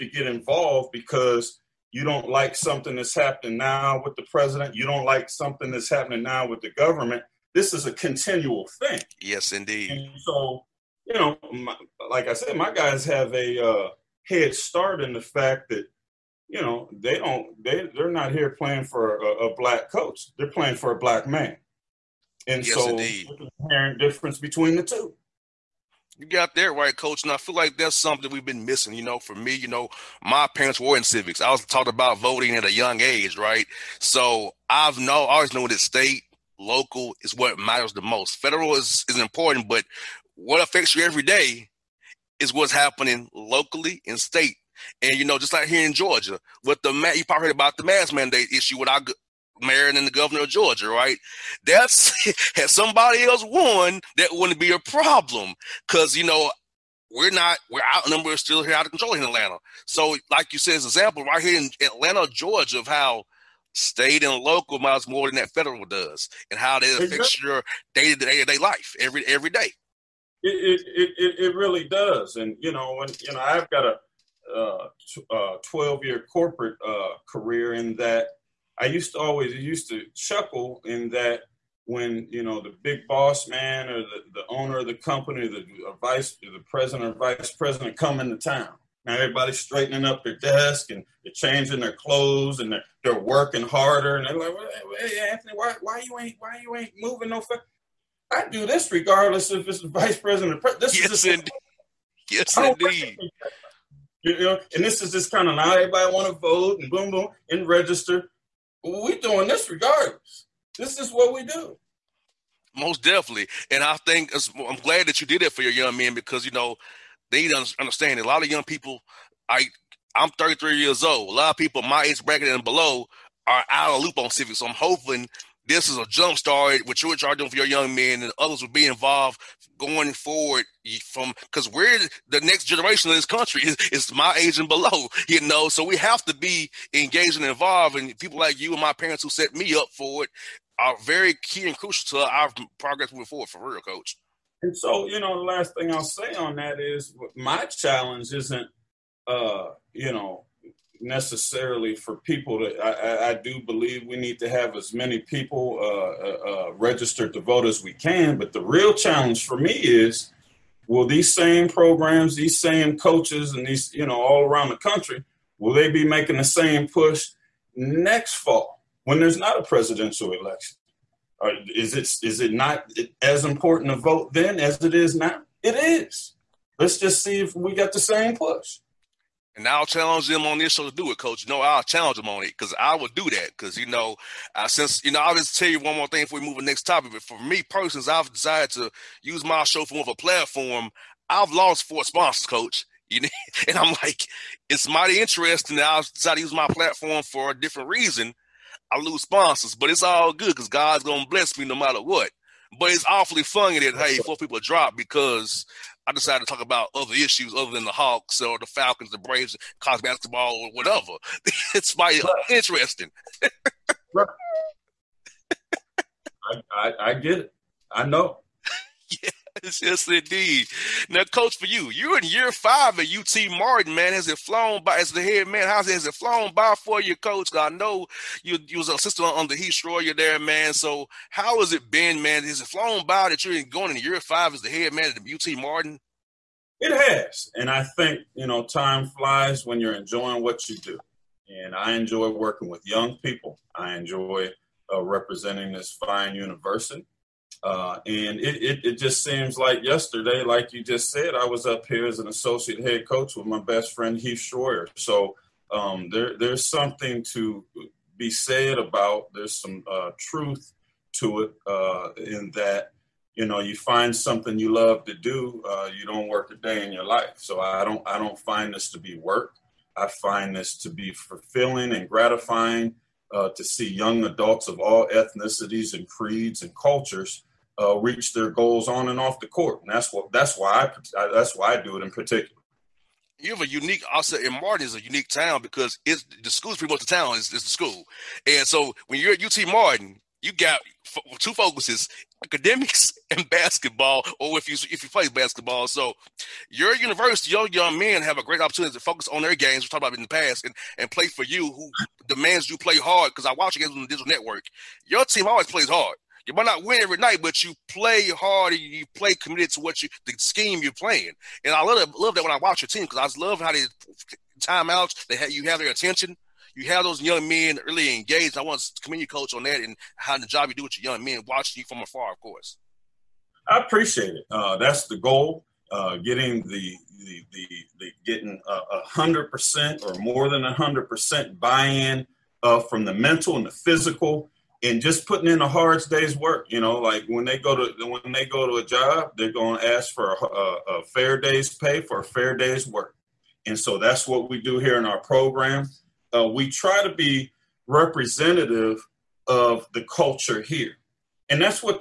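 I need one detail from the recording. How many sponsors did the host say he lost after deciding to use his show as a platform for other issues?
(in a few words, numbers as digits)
4.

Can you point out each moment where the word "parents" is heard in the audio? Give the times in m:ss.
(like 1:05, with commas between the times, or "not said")
0:30, 2:18.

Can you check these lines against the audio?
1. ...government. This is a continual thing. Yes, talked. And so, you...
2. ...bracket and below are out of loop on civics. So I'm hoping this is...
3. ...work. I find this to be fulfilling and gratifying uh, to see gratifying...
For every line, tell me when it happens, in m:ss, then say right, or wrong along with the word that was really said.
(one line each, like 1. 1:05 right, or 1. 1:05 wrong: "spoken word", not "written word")
1. 0:06 wrong: "indeed", not "talked"
2. 2:02 right
3. 4:29 wrong: "young", not "gratifying".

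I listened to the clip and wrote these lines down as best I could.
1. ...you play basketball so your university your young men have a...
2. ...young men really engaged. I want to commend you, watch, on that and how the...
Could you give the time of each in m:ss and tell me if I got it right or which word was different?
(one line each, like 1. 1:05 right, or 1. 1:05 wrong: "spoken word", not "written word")
1. 4:55 right
2. 5:17 wrong: "coach", not "watch".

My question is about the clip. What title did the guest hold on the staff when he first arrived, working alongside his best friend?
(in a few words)
associate head coach.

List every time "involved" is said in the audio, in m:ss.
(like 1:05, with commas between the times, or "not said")
0:00, 2:08, 2:17.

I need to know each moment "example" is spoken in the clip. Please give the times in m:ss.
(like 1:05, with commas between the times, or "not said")
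1:00.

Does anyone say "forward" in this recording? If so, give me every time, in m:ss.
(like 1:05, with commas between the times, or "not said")
2:10, 2:23.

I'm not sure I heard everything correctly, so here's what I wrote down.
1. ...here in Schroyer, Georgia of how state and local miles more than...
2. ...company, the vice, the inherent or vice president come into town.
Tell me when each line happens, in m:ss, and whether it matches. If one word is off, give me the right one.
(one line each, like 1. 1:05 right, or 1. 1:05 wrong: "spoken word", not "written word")
1. 1:01 wrong: "Atlanta", not "Schroyer"
2. 1:24 wrong: "president", not "inherent".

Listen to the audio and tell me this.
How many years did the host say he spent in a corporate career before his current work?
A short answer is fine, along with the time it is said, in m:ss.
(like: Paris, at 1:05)
12, at 1:15.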